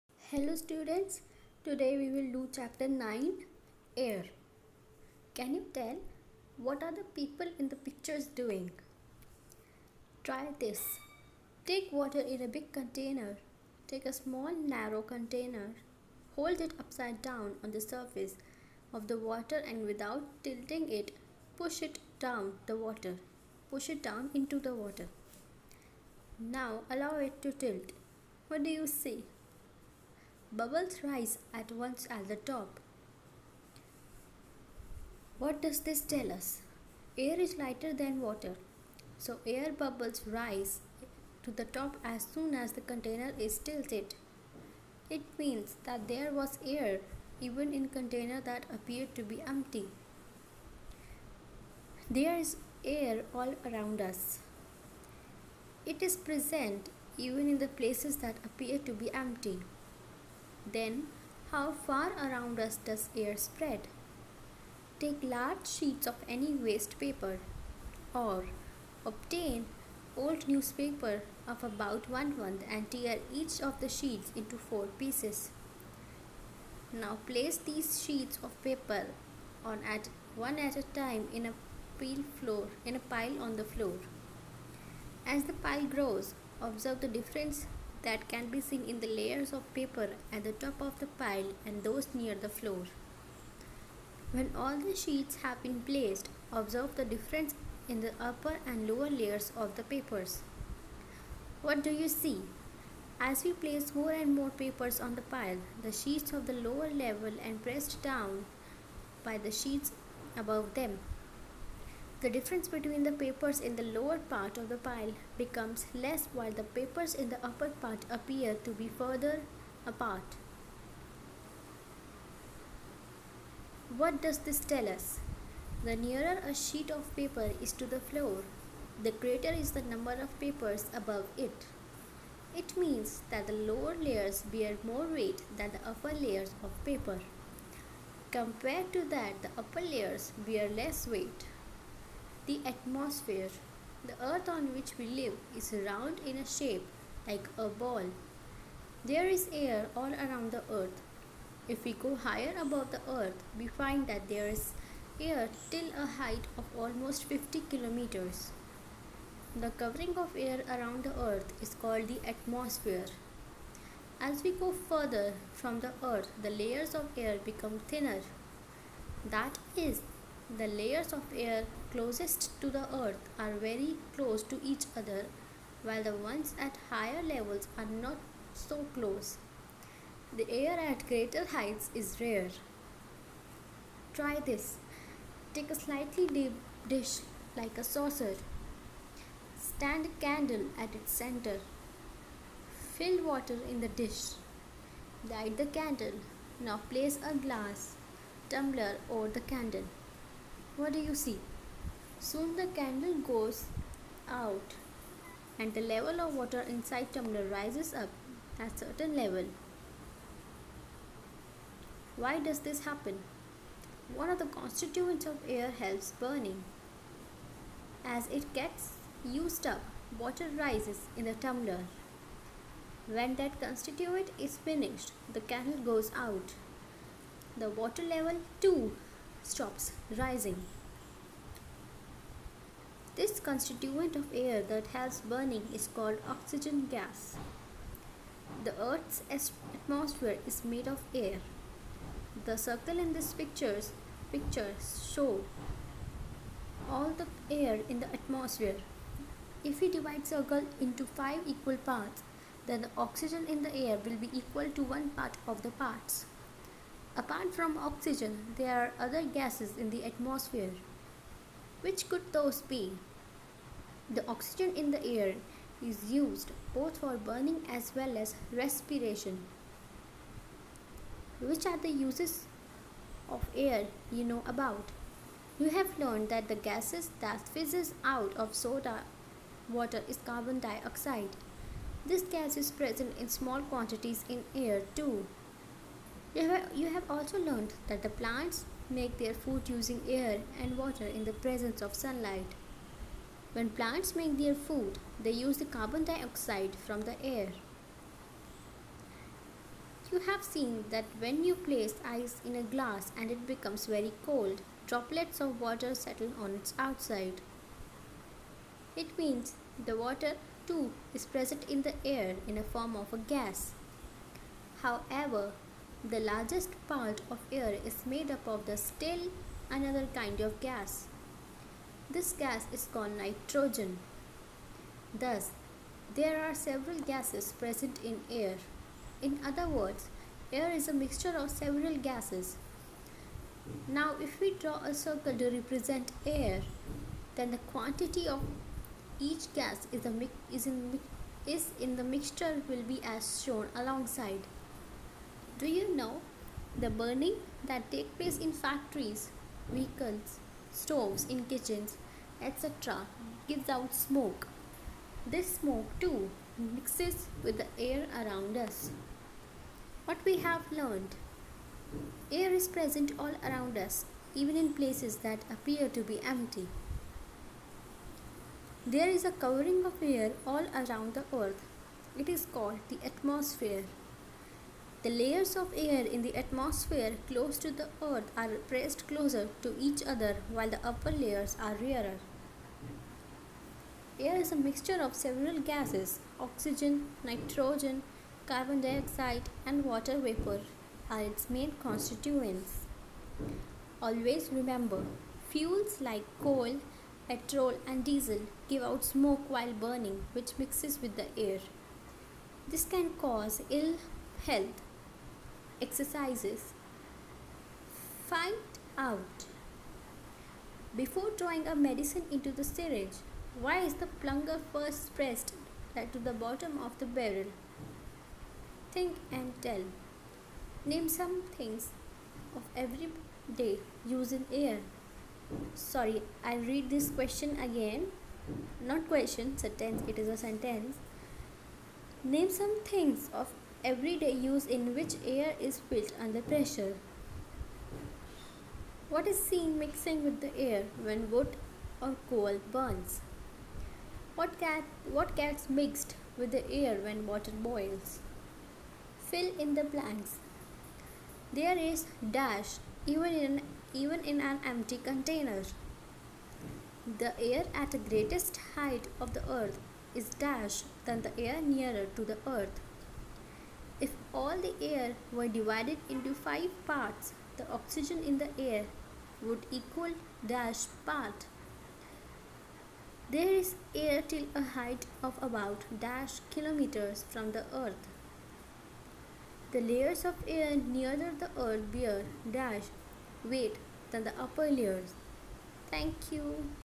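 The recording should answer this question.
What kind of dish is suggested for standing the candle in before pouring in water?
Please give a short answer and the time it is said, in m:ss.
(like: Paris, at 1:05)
a saucer, at 3:07.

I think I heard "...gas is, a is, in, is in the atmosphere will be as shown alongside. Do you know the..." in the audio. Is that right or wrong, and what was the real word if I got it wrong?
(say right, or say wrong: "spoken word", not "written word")
wrong: "mixture", not "atmosphere".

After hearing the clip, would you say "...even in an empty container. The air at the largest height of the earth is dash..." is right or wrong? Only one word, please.
wrong.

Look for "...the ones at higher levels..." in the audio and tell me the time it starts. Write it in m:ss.
2:56.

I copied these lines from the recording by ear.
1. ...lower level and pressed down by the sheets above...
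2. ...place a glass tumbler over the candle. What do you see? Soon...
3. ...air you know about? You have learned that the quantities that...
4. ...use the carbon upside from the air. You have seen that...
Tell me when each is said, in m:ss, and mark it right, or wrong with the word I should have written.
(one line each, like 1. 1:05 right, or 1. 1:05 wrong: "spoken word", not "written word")
1. 1:46 right
2. 3:16 right
3. 4:33 wrong: "gases", not "quantities"
4. 4:55 wrong: "dioxide", not "upside".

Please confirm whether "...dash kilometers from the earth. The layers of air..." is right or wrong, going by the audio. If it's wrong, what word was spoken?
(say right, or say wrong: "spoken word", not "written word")
right.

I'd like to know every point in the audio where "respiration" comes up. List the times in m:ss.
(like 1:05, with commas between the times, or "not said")
4:28.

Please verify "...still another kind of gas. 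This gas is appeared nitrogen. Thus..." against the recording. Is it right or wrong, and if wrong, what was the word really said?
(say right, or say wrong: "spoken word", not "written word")
wrong: "called", not "appeared".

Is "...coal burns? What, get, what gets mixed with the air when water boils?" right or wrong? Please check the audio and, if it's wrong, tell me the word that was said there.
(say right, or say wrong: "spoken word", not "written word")
right.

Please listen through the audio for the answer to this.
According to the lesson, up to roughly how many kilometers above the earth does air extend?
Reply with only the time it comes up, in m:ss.
2:37.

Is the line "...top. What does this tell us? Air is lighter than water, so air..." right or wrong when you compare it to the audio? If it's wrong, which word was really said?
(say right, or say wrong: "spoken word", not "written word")
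right.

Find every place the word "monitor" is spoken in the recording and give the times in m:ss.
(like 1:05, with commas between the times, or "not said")
not said.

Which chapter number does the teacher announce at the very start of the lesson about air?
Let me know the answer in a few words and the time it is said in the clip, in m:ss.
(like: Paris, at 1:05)
9, at 0:02.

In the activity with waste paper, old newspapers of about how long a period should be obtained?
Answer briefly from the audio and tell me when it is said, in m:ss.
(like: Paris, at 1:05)
one month, at 1:12.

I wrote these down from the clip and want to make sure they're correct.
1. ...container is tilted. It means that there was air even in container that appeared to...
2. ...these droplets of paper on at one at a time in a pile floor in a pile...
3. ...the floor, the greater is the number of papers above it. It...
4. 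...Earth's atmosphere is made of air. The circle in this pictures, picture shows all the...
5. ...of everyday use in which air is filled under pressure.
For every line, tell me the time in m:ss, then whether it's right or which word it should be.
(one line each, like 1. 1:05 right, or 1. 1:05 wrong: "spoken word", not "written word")
1. 0:42 right
2. 1:17 wrong: "sheets", not "droplets"
3. 2:07 right
4. 3:58 right
5. 7:13 right.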